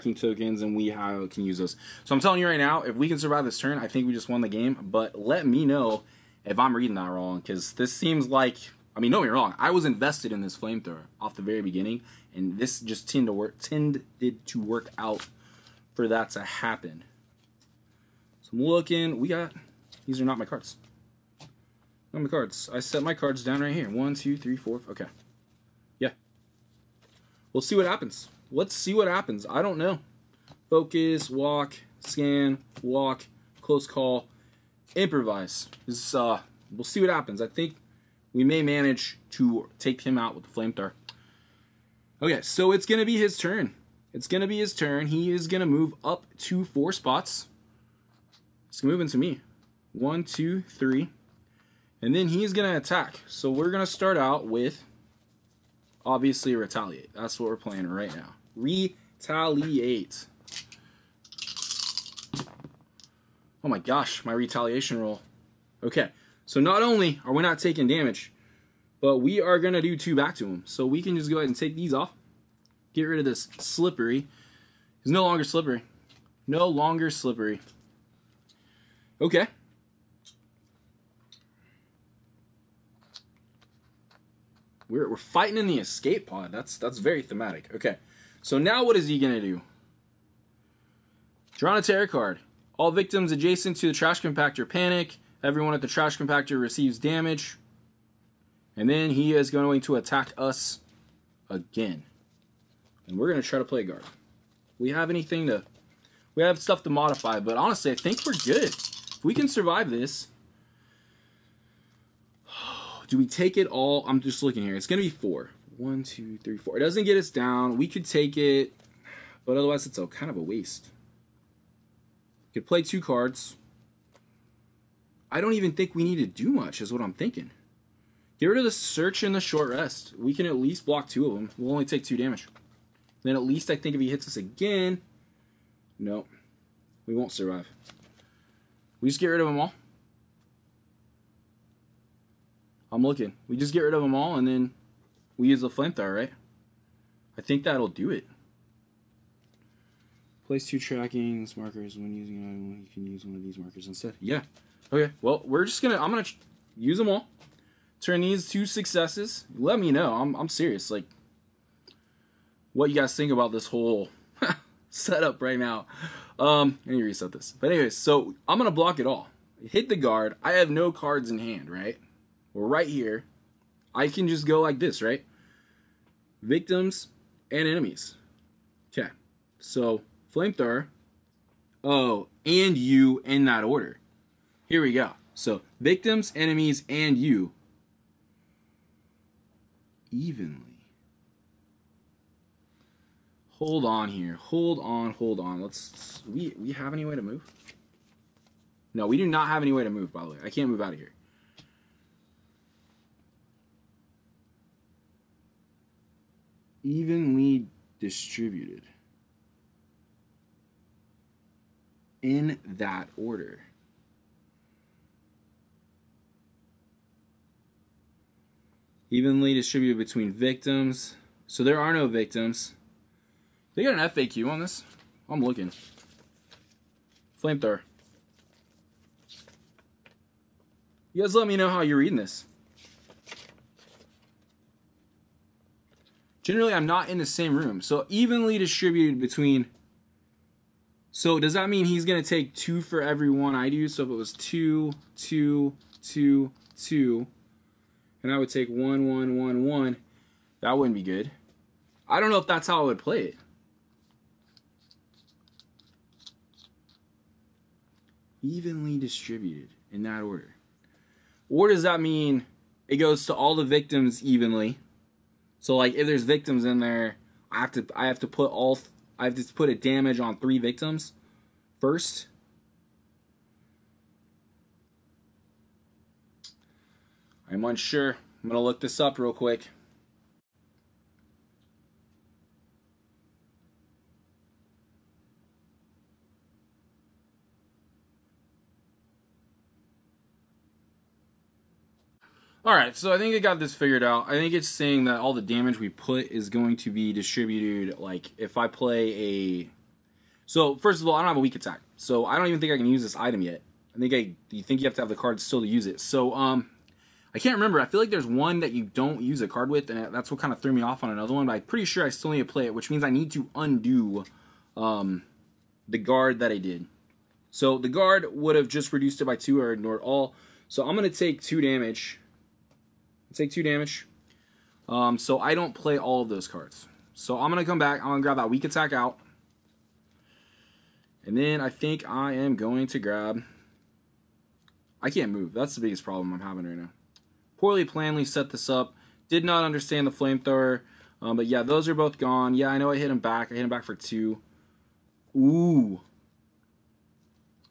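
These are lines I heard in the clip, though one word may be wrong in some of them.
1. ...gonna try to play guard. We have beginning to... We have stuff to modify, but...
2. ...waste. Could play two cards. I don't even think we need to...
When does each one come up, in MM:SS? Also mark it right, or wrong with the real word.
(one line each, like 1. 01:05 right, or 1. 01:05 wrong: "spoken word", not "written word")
1. 01:43 wrong: "anything", not "beginning"
2. 02:00 right.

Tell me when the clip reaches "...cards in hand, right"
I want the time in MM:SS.
02:50.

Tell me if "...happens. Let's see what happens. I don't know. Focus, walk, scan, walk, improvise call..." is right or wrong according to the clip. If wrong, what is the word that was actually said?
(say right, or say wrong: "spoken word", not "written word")
wrong: "close", not "improvise".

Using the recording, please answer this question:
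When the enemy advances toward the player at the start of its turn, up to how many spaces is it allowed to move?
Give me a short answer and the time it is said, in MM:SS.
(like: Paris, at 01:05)
4, at 00:46.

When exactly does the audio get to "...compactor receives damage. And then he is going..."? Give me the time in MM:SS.
01:36.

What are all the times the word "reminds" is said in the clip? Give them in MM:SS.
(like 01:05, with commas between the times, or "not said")
not said.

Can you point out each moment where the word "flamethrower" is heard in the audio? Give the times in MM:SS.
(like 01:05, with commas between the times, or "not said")
00:10, 00:40, 02:25, 03:00, 03:47, 05:40.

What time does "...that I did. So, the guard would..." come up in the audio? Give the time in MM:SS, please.
05:16.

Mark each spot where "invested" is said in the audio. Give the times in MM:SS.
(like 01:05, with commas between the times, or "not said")
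00:09.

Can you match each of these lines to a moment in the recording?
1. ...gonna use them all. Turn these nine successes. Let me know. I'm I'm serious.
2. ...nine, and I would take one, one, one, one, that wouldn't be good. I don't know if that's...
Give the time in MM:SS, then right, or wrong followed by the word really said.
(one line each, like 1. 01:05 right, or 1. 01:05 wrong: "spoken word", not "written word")
1. 02:36 wrong: "two", not "nine"
2. 04:06 wrong: "two", not "nine".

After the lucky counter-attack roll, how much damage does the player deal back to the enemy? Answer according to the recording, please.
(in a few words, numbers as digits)
2.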